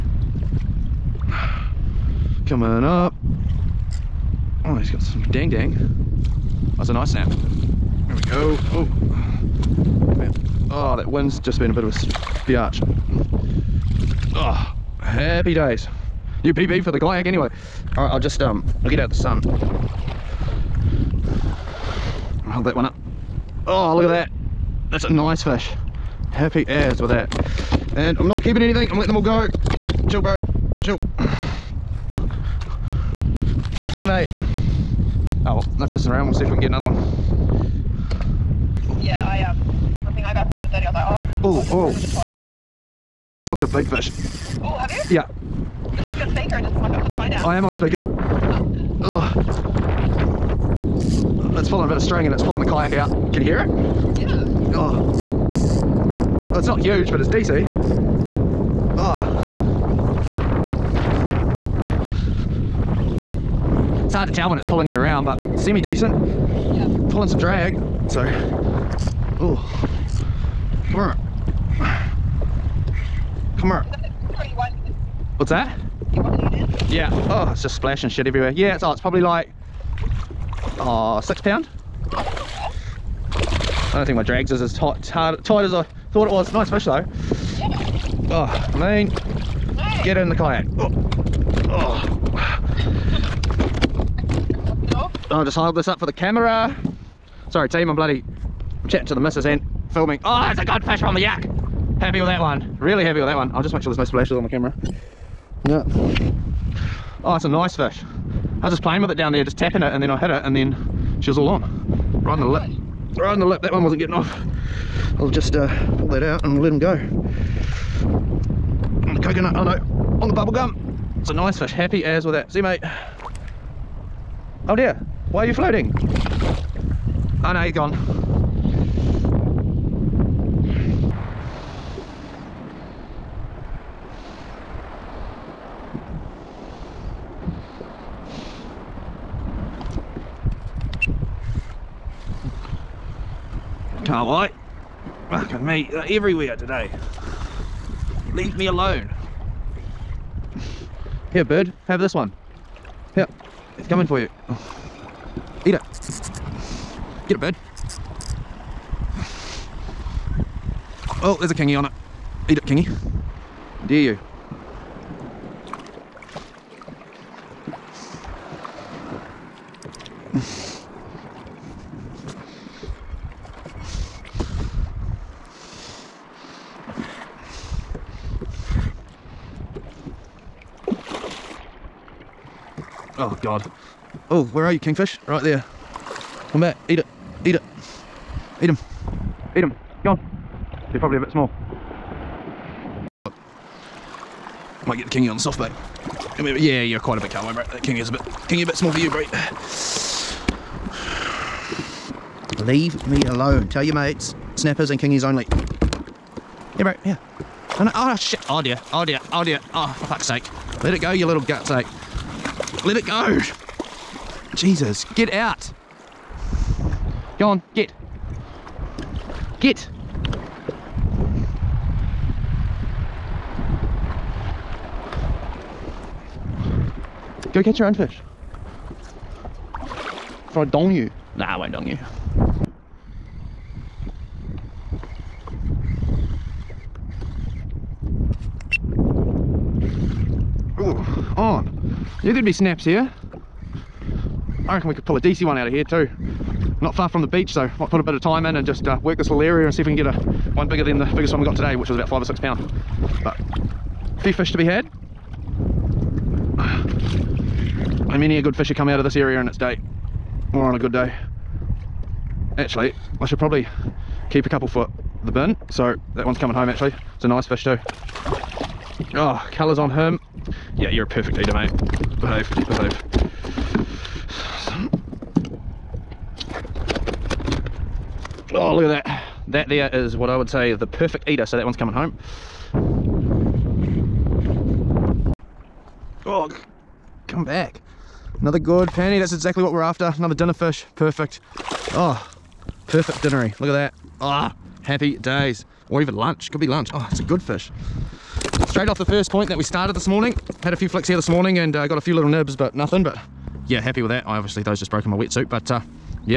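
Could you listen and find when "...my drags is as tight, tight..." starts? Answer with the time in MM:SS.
01:24.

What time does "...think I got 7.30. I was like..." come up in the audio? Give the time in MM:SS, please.
00:40.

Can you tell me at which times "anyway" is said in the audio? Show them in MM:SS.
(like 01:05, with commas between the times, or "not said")
00:17.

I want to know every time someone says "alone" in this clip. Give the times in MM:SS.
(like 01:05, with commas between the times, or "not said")
02:28, 03:23.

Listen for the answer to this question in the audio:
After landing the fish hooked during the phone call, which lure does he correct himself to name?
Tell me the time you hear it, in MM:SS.
02:00.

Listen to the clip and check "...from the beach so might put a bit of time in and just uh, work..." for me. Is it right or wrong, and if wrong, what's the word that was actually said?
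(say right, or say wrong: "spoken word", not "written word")
right.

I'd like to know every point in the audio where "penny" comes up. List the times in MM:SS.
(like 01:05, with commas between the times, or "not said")
04:48.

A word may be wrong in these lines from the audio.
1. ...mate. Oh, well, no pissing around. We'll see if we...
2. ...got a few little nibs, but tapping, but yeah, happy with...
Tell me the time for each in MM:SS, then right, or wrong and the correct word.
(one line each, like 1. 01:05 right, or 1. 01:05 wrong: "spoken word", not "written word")
1. 00:34 right
2. 05:01 wrong: "nothing", not "tapping".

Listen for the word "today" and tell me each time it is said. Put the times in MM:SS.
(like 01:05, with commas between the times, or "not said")
02:26, 04:11.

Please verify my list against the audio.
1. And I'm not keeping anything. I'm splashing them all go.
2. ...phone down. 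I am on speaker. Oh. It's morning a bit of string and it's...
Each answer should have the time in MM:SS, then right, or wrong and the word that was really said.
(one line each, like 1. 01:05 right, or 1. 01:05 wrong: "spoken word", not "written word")
1. 00:27 wrong: "letting", not "splashing"
2. 00:47 wrong: "pulling", not "morning".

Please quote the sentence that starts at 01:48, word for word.
I was just playing with it down there, just tapping it, and then I hit it, and then she was all on.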